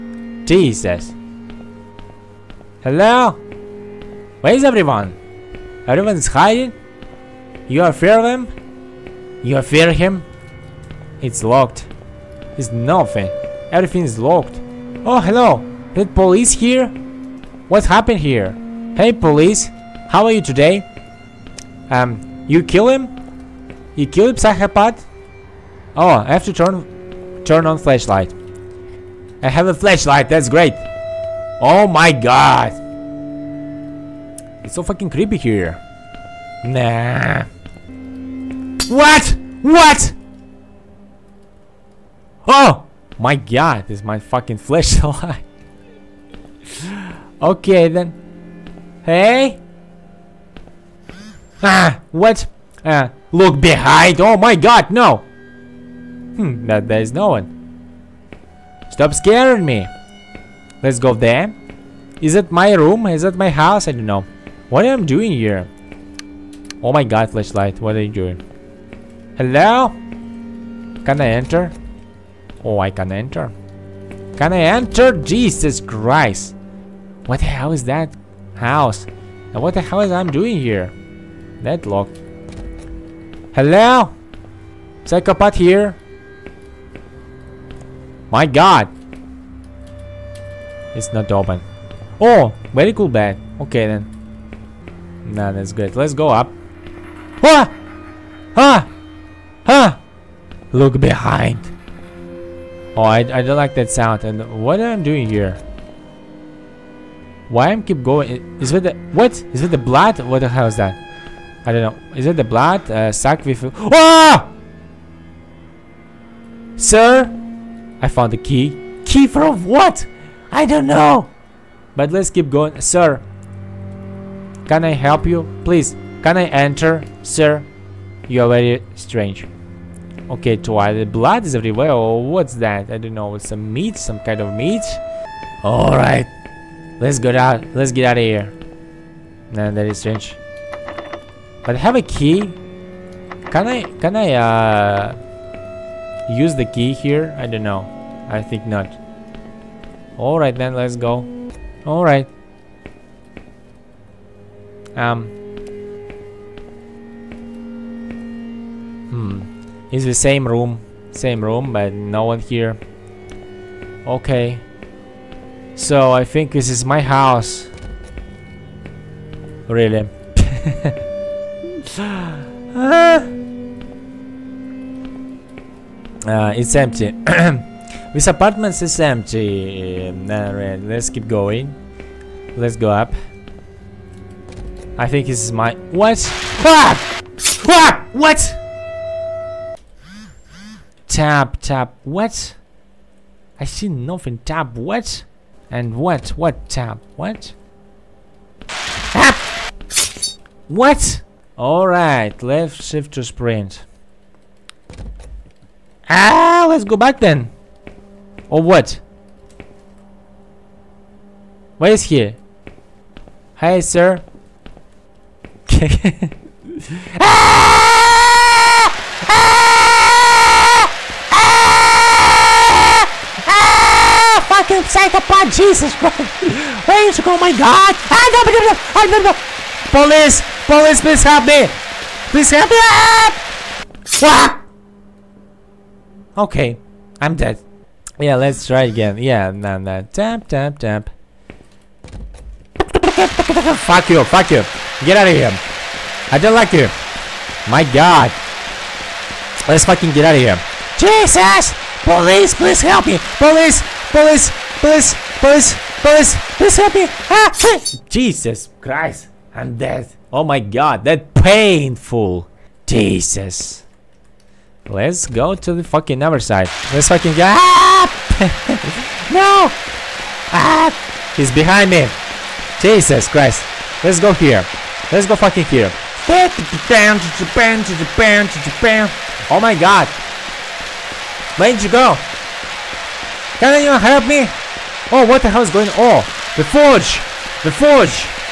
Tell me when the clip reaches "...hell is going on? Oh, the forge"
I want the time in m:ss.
4:45.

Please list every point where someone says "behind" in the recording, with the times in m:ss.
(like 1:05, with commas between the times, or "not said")
0:53, 1:40, 4:31.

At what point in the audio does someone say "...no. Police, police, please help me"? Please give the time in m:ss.
3:49.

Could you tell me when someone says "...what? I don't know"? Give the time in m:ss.
1:59.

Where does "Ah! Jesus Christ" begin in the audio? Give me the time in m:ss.
4:17.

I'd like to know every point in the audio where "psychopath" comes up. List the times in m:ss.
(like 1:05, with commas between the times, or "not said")
0:24, 1:25, 3:44.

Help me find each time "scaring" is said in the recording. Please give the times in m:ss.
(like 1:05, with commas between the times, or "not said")
0:59.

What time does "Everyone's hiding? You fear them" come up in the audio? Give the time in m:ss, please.
0:05.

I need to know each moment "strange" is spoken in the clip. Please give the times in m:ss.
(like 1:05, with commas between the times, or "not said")
2:08, 2:19.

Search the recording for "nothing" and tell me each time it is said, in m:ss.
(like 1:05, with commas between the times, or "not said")
0:12, 3:13.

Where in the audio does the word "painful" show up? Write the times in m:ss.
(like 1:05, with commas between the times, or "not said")
4:21.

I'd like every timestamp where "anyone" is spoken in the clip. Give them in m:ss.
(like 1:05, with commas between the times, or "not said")
4:43.